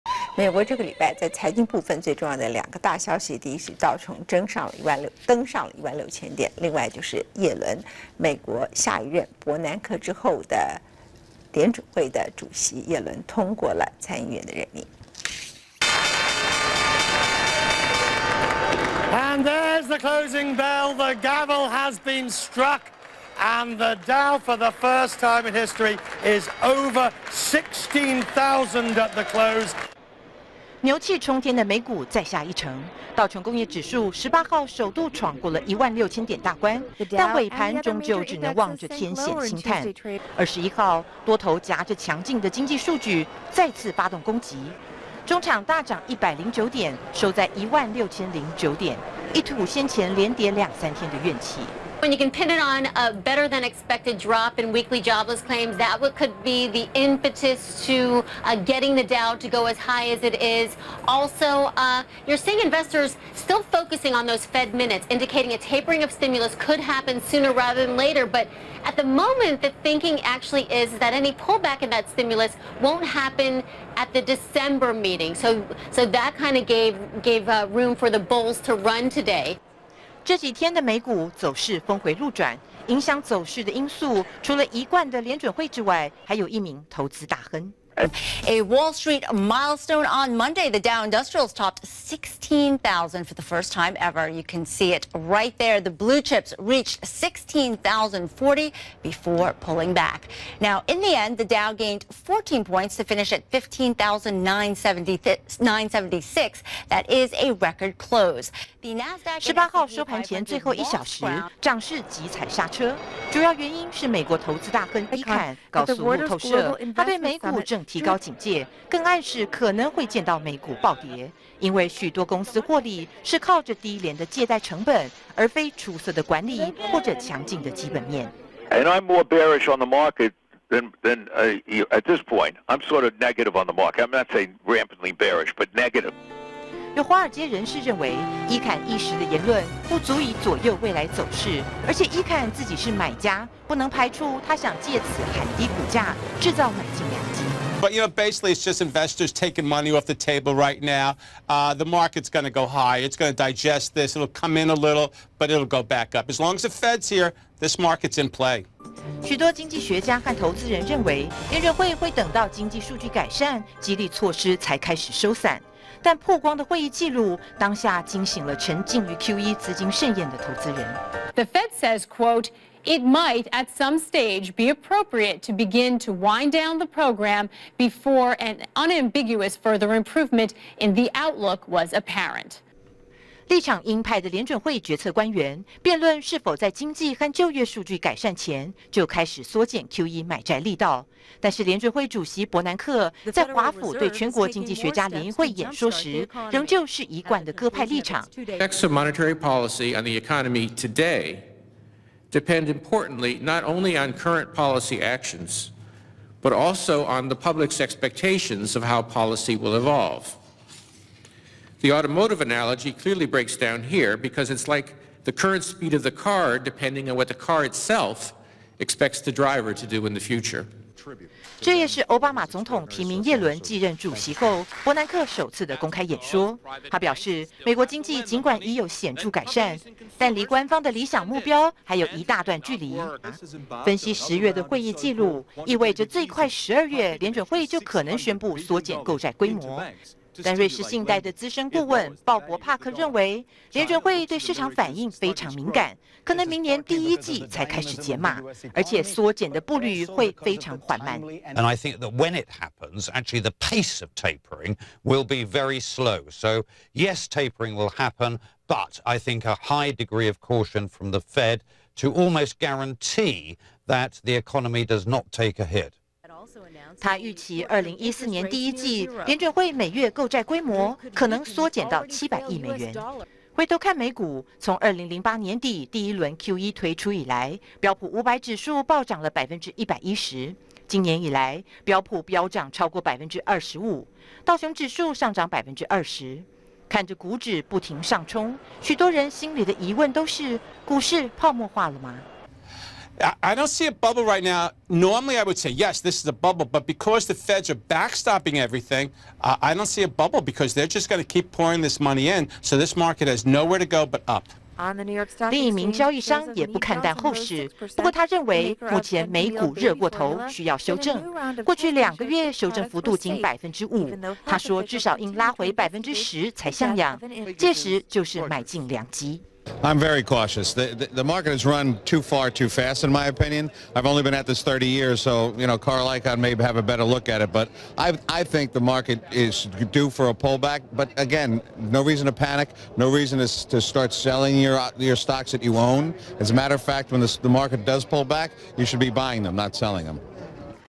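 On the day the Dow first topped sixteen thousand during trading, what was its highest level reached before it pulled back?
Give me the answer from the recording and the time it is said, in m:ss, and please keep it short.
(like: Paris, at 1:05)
16,040, at 1:37.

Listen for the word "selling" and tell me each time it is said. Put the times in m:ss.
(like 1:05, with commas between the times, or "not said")
5:34, 5:39.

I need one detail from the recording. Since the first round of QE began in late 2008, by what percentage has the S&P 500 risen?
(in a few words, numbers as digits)
110%.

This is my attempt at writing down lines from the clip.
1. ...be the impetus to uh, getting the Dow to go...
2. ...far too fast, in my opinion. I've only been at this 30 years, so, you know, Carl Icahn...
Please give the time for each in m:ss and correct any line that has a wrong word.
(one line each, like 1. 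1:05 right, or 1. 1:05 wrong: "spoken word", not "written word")
1. 0:56 right
2. 5:22 right.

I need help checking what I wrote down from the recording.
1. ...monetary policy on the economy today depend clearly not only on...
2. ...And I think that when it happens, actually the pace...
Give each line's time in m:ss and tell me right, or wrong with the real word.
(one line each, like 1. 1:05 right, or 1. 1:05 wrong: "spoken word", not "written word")
1. 3:18 wrong: "importantly", not "clearly"
2. 4:11 right.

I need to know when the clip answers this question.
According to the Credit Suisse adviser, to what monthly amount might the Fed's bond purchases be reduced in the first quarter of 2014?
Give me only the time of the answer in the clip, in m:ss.
4:32.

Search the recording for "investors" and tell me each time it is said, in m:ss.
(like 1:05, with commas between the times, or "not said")
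1:02, 2:28.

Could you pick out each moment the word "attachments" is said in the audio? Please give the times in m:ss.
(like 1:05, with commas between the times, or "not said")
not said.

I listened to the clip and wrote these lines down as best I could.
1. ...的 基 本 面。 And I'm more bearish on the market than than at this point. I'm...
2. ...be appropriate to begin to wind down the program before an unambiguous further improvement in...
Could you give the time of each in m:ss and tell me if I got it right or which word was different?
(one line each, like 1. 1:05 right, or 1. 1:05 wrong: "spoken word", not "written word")
1. 2:07 right
2. 2:54 right.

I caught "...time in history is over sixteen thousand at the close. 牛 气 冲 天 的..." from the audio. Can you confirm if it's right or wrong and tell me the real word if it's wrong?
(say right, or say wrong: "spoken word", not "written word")
right.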